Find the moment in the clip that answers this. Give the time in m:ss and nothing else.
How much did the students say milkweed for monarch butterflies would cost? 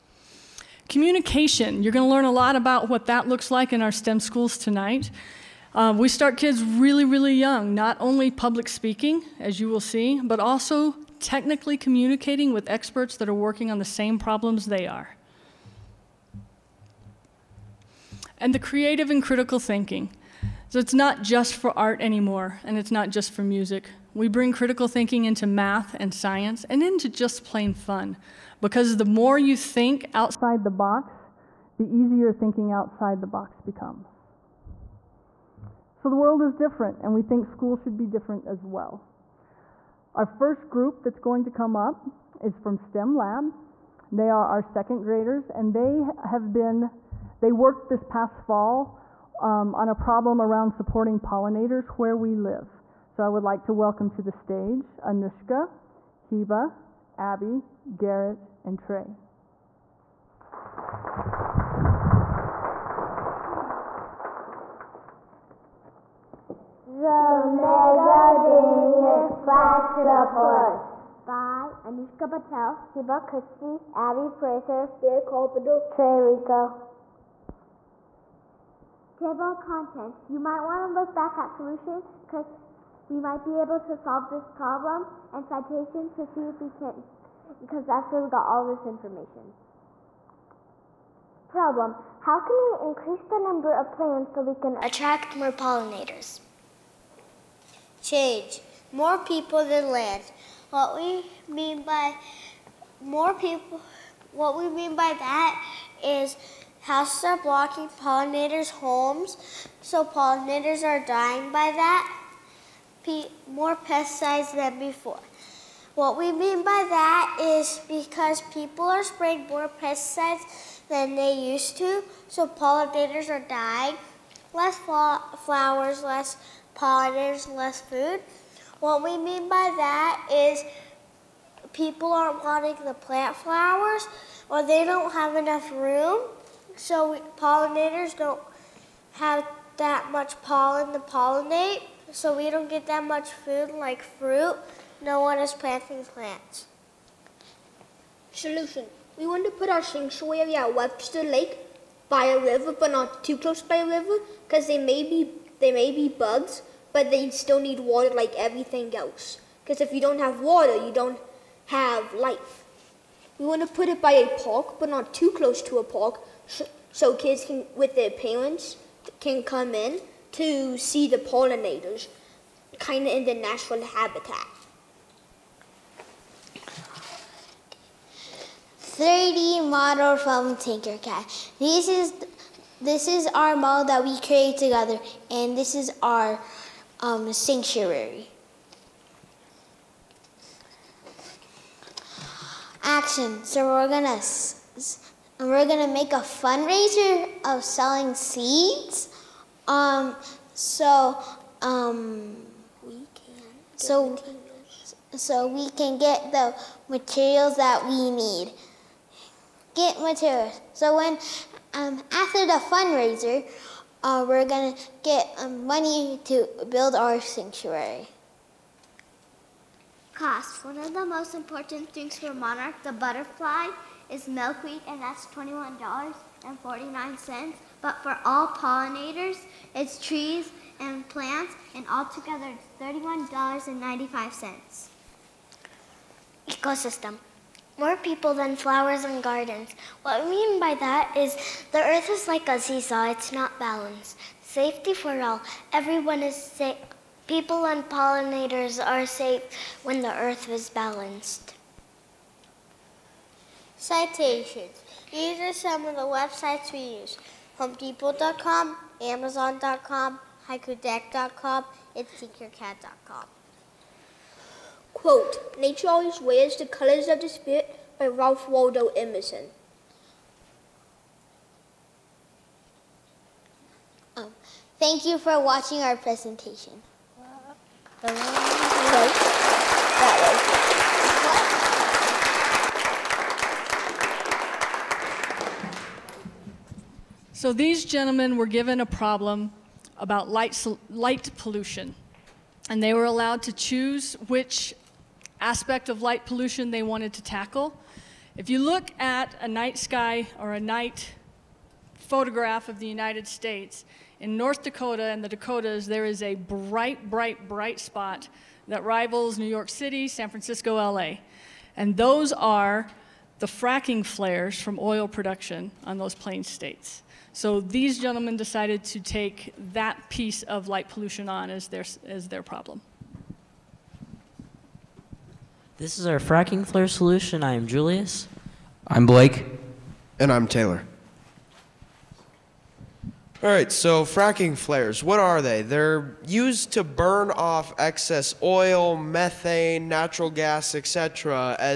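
3:45.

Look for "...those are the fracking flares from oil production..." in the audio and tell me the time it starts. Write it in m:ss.
5:11.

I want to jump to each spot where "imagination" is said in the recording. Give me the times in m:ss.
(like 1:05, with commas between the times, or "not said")
not said.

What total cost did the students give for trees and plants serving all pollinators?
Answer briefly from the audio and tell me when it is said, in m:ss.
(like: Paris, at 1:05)
$31.95, at 3:52.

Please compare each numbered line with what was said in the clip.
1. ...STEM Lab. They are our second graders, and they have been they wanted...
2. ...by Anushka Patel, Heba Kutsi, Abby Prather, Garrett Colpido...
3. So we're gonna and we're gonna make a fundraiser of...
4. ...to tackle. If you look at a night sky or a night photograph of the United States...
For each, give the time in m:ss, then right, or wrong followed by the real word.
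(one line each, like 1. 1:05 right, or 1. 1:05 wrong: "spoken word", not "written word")
1. 0:42 wrong: "worked", not "wanted"
2. 1:11 right
3. 3:13 right
4. 4:57 right.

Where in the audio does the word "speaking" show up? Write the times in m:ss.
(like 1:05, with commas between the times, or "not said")
0:08.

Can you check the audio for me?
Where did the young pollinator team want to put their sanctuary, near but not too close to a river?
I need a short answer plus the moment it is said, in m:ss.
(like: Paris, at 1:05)
Webster Lake, at 2:30.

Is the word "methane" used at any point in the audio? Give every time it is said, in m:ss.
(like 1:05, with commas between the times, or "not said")
5:38.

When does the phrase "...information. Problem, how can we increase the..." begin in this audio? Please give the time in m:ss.
1:28.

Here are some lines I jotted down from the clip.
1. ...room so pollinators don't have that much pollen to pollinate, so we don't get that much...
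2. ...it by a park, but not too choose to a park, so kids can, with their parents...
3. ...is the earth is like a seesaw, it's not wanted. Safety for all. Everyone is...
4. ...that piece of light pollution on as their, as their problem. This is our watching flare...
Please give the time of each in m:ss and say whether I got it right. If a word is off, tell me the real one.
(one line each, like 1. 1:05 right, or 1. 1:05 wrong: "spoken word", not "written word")
1. 2:15 right
2. 2:43 wrong: "close", not "choose"
3. 4:01 wrong: "balanced", not "wanted"
4. 5:19 wrong: "fracking", not "watching".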